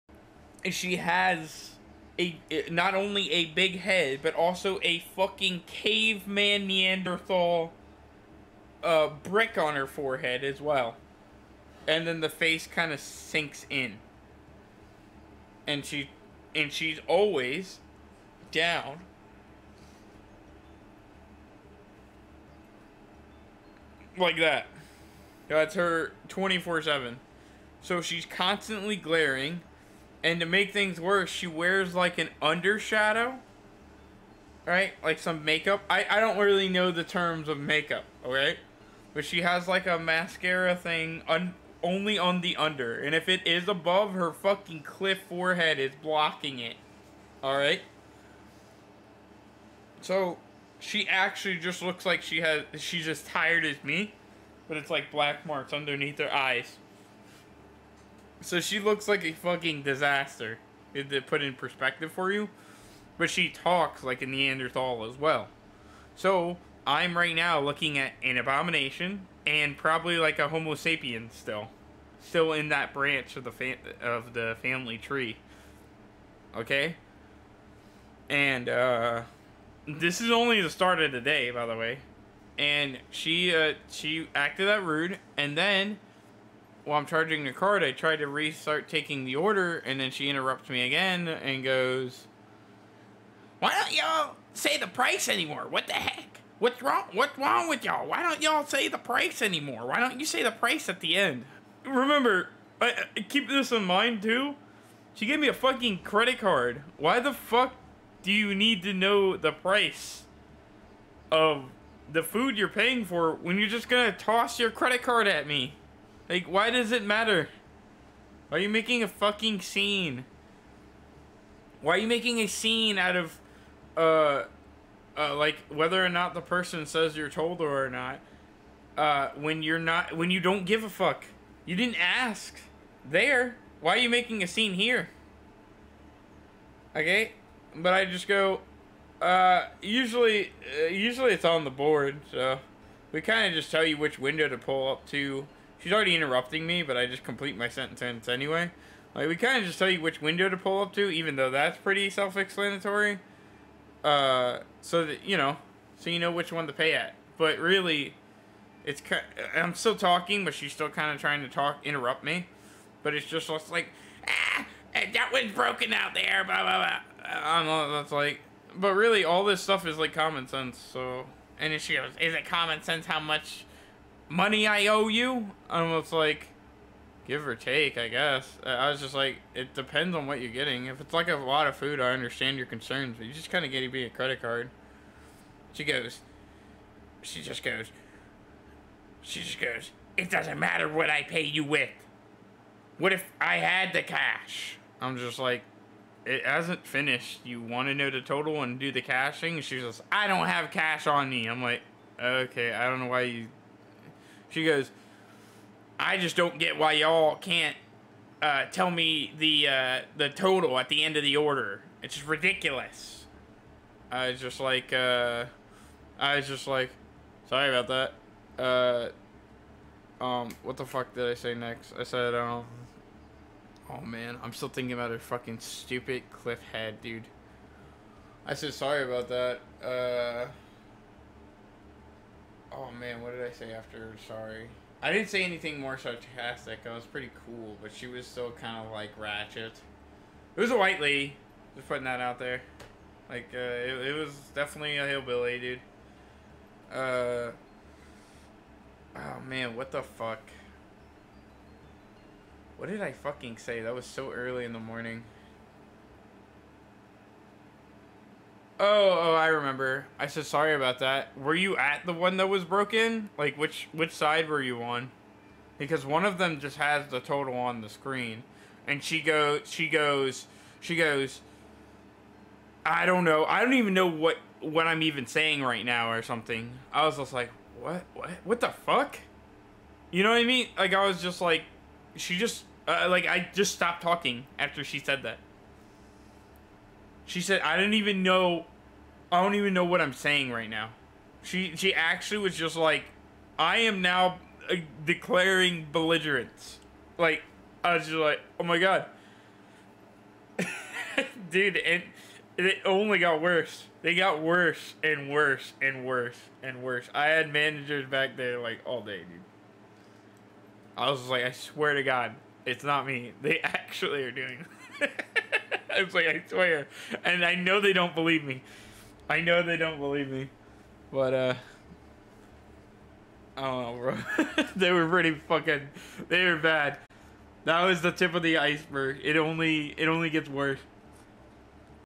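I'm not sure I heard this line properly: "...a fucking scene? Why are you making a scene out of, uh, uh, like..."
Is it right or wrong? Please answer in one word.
right.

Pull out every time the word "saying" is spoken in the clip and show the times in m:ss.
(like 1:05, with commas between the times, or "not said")
4:35, 4:50.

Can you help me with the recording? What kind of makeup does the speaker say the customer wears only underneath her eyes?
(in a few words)
Mascara.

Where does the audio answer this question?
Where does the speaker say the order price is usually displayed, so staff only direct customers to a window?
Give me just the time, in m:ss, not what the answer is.
2:21.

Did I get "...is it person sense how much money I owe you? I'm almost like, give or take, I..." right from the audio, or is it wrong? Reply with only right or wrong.
wrong.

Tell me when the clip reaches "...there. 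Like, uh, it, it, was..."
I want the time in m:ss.
4:02.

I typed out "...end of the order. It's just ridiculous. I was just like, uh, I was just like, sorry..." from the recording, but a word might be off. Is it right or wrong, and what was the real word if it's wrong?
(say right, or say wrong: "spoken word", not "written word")
right.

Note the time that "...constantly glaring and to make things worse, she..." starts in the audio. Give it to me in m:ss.
0:28.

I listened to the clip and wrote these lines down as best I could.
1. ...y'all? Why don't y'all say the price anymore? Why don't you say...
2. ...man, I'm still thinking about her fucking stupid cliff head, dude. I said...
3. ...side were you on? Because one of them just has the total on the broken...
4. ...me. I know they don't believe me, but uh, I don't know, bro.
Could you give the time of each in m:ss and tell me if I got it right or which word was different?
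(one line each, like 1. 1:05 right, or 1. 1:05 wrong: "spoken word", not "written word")
1. 1:37 right
2. 3:44 right
3. 4:24 wrong: "screen", not "broken"
4. 5:18 right.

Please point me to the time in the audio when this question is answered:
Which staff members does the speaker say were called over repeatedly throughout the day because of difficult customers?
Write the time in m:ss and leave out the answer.
5:07.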